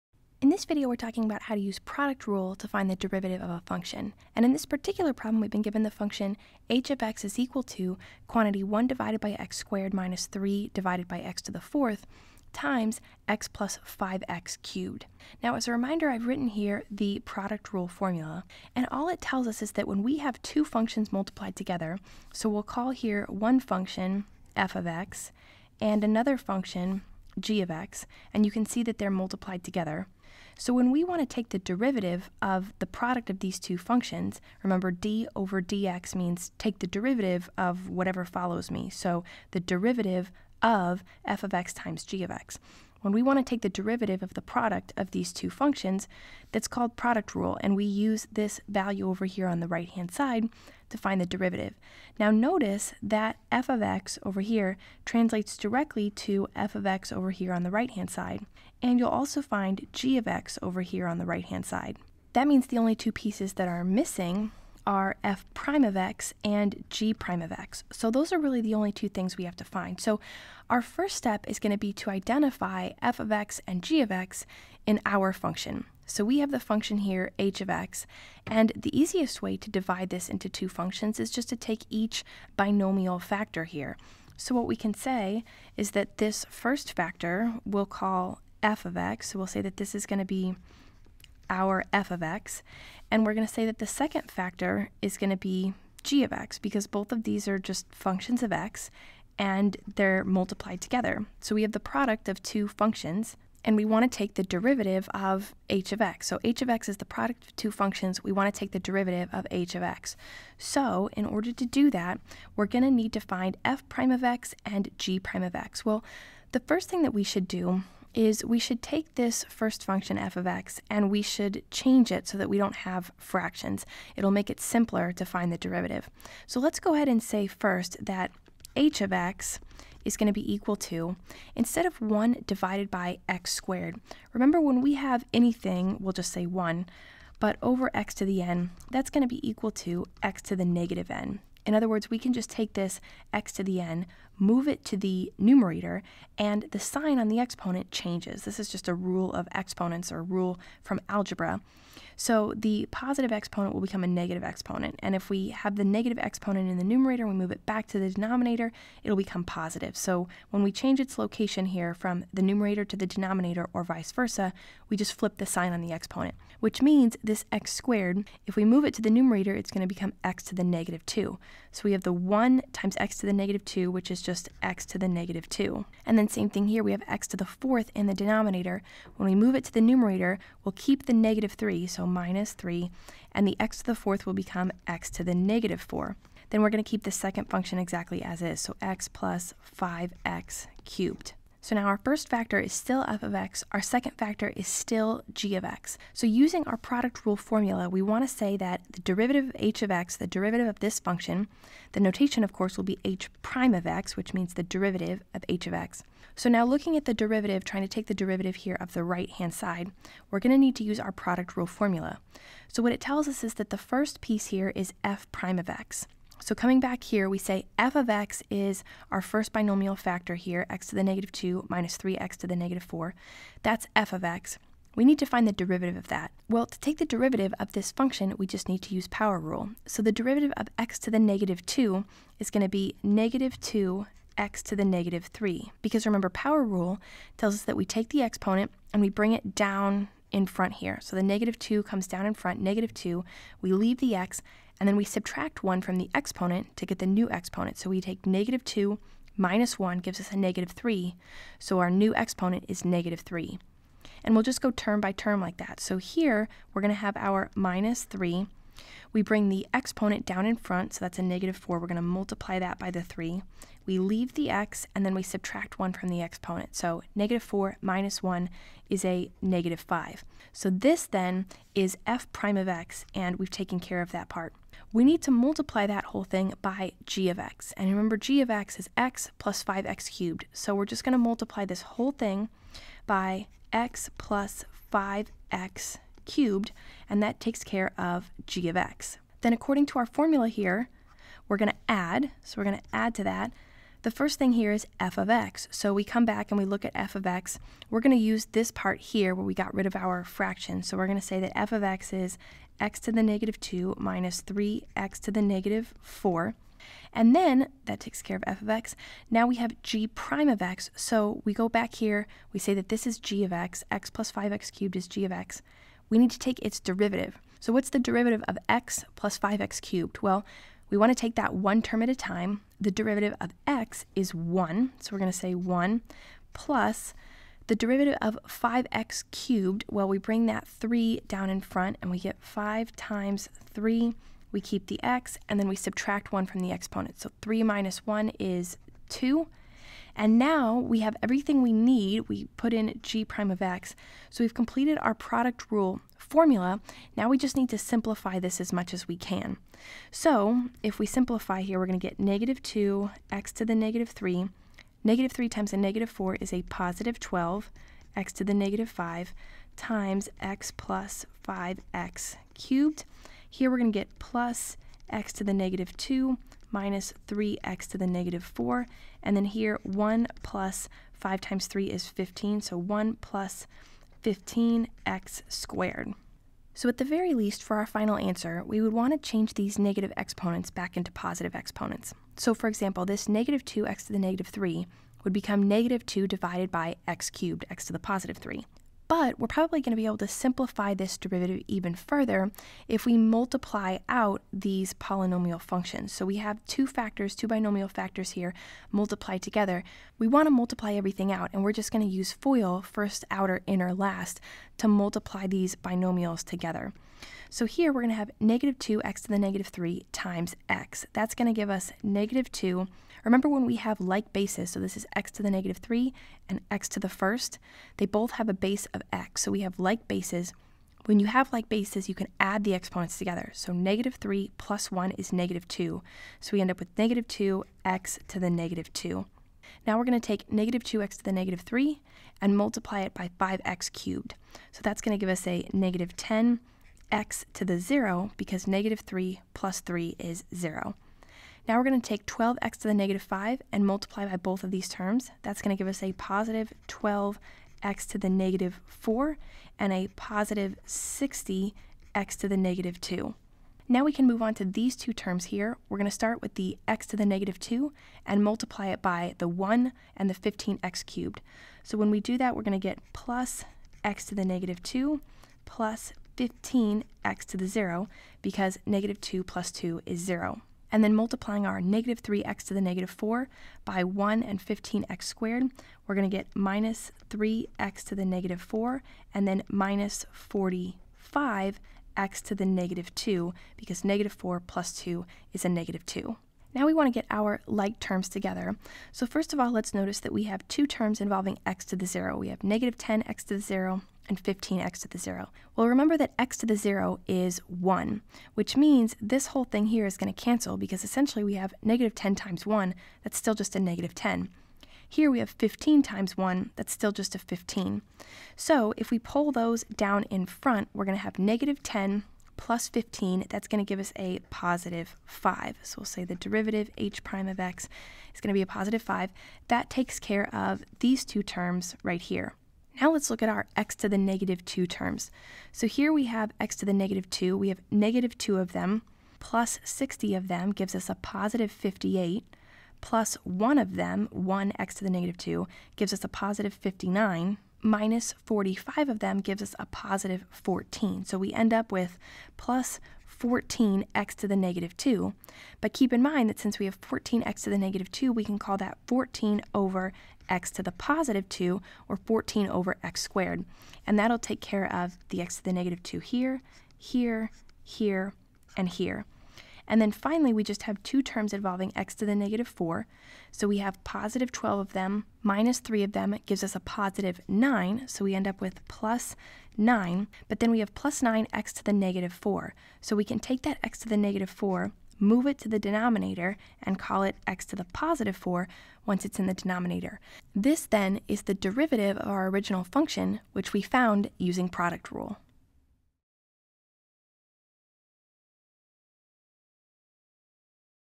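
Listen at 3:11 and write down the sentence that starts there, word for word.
So now our first factor is still f of x, our second factor is still g of x.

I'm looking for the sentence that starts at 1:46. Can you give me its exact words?
So h of x is the product of two functions.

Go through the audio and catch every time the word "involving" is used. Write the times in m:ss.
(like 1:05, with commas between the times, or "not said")
8:11, 9:21.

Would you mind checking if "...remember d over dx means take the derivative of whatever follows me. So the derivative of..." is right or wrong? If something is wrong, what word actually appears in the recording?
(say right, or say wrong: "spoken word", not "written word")
right.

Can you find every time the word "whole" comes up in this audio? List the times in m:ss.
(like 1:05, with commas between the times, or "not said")
4:36, 4:41, 8:19.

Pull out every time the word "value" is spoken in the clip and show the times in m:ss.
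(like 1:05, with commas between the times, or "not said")
0:48.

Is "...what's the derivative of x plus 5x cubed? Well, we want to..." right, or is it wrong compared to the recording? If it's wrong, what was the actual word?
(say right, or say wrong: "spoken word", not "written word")
right.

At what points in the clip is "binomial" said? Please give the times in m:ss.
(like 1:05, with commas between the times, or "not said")
1:22, 3:39, 6:37, 6:45.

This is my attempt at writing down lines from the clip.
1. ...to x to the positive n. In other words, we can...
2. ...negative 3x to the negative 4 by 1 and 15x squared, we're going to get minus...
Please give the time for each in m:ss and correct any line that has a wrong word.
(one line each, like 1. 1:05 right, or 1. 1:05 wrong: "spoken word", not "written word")
1. 2:19 wrong: "negative", not "positive"
2. 7:51 right.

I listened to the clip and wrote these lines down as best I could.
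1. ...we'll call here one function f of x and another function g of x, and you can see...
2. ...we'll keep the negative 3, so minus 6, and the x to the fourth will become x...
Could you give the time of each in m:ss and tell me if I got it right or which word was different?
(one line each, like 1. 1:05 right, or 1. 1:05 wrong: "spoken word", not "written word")
1. 0:22 right
2. 3:00 wrong: "3", not "6".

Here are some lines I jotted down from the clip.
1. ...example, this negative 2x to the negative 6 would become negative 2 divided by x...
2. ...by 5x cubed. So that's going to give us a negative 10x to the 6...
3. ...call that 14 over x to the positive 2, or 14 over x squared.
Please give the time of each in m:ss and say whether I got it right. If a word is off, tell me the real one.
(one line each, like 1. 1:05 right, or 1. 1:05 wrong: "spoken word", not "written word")
1. 6:22 wrong: "3", not "6"
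2. 7:13 wrong: "0", not "6"
3. 9:08 right.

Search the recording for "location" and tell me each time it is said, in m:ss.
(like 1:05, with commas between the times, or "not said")
2:41.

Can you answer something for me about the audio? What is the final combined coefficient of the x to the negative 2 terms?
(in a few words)
14.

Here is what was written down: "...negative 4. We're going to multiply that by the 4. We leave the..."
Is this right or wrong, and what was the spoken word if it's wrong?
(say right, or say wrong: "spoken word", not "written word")
wrong: "3", not "4".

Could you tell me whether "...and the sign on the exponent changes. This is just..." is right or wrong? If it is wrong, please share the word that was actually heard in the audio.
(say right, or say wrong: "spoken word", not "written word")
right.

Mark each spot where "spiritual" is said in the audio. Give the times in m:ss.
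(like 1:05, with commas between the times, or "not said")
not said.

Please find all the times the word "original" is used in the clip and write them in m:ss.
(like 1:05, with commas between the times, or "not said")
9:42.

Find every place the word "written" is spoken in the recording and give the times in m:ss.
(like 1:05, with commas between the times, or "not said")
0:16.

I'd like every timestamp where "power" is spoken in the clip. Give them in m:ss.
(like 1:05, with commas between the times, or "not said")
3:49, 3:56.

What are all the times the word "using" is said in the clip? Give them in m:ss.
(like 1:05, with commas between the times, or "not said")
3:16, 9:44.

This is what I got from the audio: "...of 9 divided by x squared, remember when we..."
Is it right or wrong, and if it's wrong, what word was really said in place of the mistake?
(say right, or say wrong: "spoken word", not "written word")
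wrong: "1", not "9".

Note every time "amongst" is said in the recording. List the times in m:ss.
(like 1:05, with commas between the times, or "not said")
not said.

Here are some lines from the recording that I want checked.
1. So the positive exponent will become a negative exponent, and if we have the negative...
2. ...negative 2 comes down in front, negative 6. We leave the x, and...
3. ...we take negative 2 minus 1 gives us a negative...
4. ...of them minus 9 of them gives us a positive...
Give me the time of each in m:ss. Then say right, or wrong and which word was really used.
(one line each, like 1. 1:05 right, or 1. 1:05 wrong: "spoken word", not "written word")
1. 2:32 right
2. 4:01 wrong: "2", not "6"
3. 4:07 right
4. 9:24 wrong: "3", not "9".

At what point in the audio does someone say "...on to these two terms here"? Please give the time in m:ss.
7:34.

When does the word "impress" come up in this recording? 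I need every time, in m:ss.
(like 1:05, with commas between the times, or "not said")
not said.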